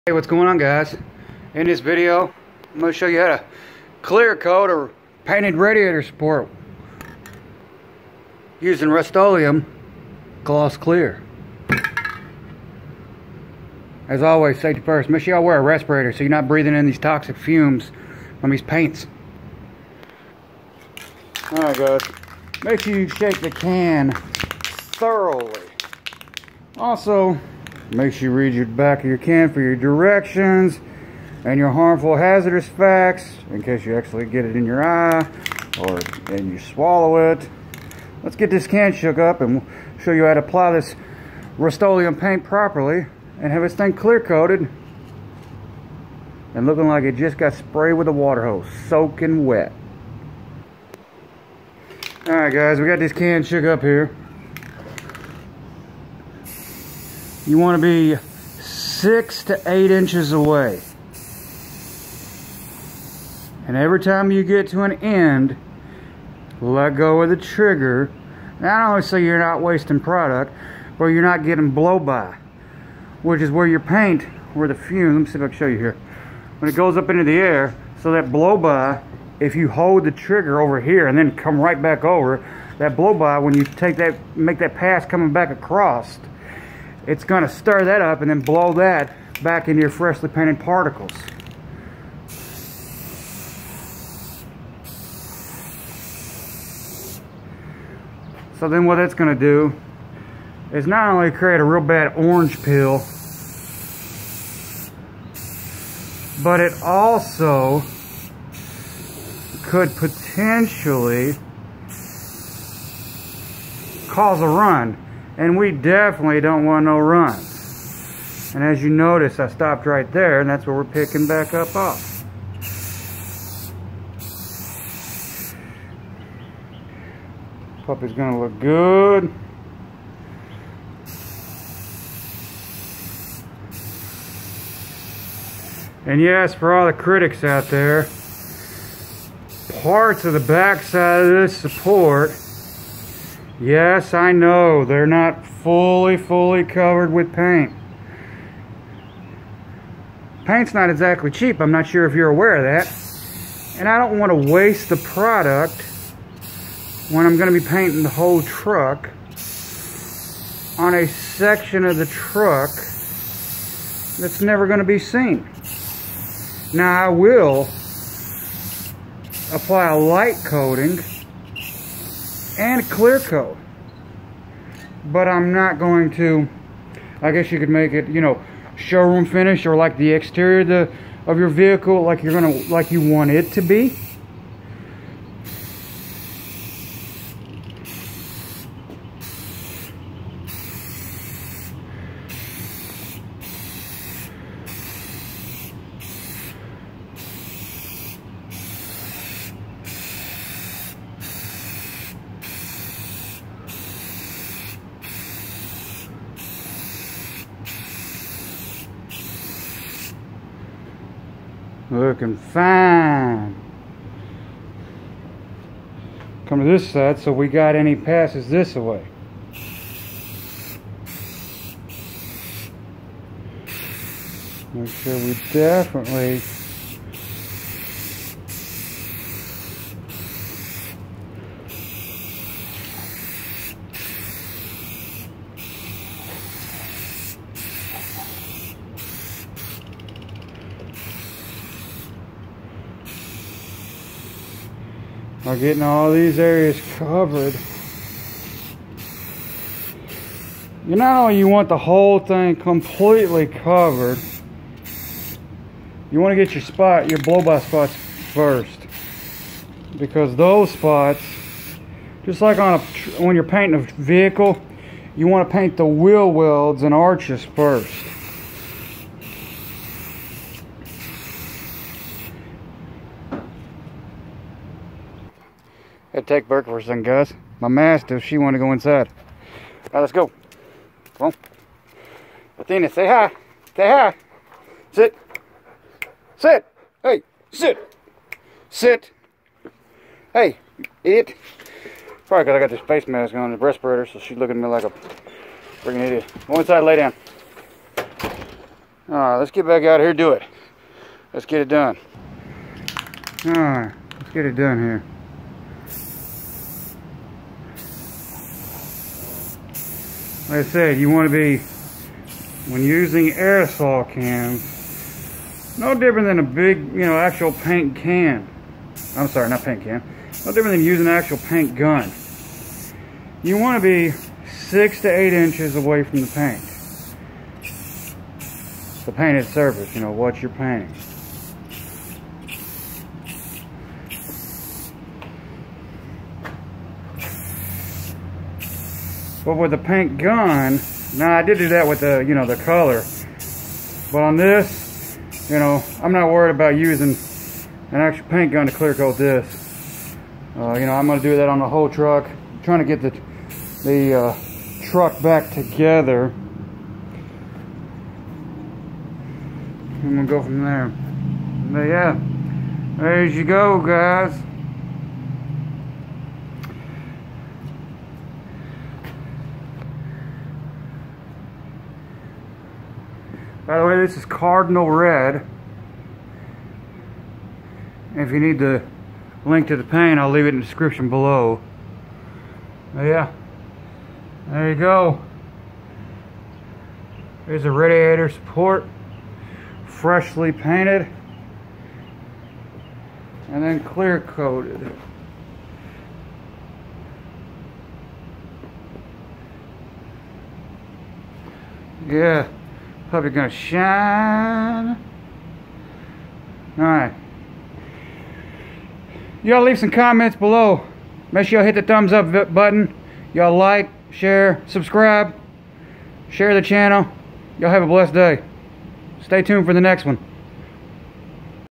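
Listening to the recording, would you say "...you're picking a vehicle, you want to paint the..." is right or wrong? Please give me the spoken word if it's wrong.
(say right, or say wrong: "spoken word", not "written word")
wrong: "painting", not "picking".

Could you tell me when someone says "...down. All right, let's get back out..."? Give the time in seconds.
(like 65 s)
296 s.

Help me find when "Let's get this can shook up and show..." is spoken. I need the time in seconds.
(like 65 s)
38 s.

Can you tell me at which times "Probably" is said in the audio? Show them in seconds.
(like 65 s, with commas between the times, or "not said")
292 s, 403 s.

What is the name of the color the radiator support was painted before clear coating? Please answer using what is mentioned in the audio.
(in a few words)
Cardinal Red.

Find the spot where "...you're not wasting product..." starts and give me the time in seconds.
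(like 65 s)
69 s.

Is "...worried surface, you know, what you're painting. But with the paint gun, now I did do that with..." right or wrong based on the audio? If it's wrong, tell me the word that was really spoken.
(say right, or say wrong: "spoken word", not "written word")
wrong: "painted", not "worried".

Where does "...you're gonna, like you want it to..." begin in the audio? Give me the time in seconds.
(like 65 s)
182 s.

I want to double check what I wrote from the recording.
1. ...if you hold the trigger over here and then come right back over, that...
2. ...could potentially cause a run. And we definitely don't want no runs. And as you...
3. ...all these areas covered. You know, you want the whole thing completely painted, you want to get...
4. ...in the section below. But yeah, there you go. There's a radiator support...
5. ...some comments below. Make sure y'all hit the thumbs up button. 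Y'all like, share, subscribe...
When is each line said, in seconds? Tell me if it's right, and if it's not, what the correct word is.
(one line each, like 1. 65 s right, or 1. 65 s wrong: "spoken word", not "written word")
1. 79 s right
2. 109 s right
3. 245 s wrong: "covered", not "painted"
4. 380 s wrong: "description", not "section"
5. 409 s right.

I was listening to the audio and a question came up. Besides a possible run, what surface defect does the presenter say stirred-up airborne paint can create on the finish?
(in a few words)
orange peel.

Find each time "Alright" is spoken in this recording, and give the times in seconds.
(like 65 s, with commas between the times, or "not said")
21 s, 52 s.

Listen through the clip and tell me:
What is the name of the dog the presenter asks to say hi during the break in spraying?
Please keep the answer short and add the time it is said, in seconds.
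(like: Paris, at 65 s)
Athena, at 282 s.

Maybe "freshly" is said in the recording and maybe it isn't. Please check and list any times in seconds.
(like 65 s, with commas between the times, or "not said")
89 s, 389 s.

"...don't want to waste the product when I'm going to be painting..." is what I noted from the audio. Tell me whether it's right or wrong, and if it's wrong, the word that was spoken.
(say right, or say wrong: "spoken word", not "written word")
right.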